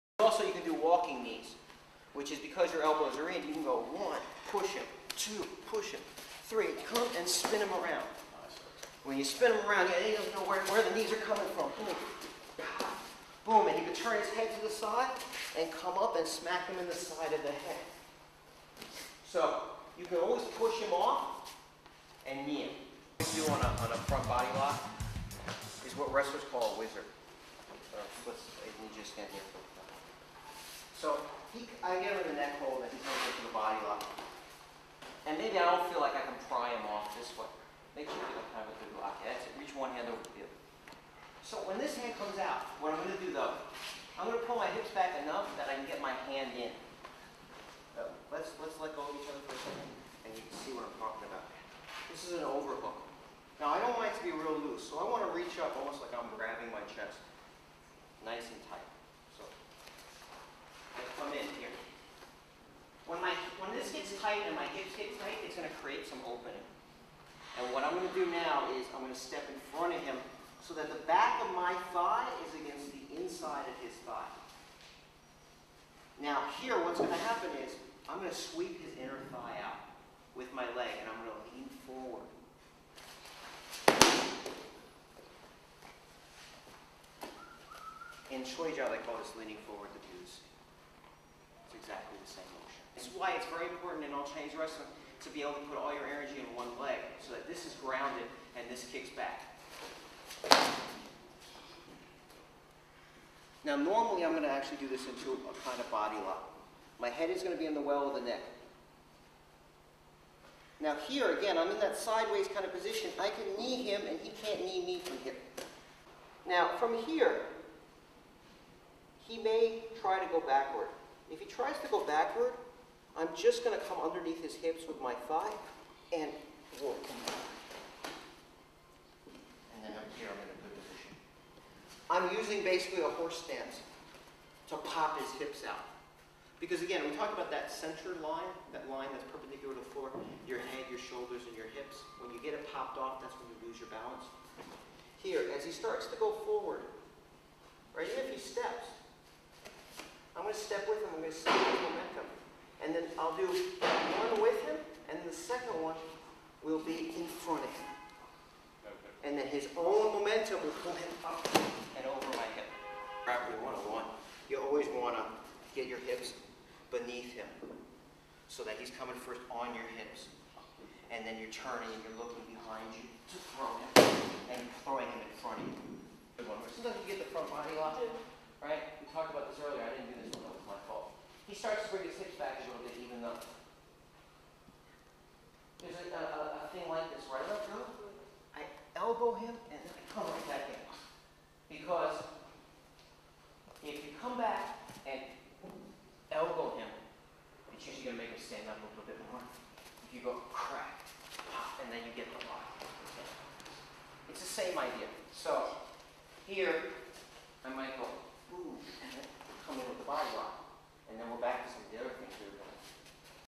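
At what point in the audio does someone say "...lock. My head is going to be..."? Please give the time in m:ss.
1:46.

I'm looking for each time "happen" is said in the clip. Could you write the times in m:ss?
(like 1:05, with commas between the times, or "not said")
1:17.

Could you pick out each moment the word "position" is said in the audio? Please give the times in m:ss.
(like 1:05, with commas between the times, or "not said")
1:52, 2:10.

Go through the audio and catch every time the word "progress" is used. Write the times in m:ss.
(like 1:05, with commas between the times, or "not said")
not said.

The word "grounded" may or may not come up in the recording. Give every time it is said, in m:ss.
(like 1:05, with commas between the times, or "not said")
1:37.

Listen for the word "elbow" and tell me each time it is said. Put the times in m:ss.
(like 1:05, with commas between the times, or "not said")
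0:02, 3:08, 3:16.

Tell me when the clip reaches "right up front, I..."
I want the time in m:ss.
3:07.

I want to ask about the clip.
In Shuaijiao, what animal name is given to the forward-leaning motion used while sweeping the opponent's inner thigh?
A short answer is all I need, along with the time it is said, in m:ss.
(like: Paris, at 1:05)
The goose, at 1:29.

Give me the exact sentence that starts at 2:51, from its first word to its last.
And then you're turning and you're looking behind you to throw him and throwing him in front of you.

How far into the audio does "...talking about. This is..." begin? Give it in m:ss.
0:51.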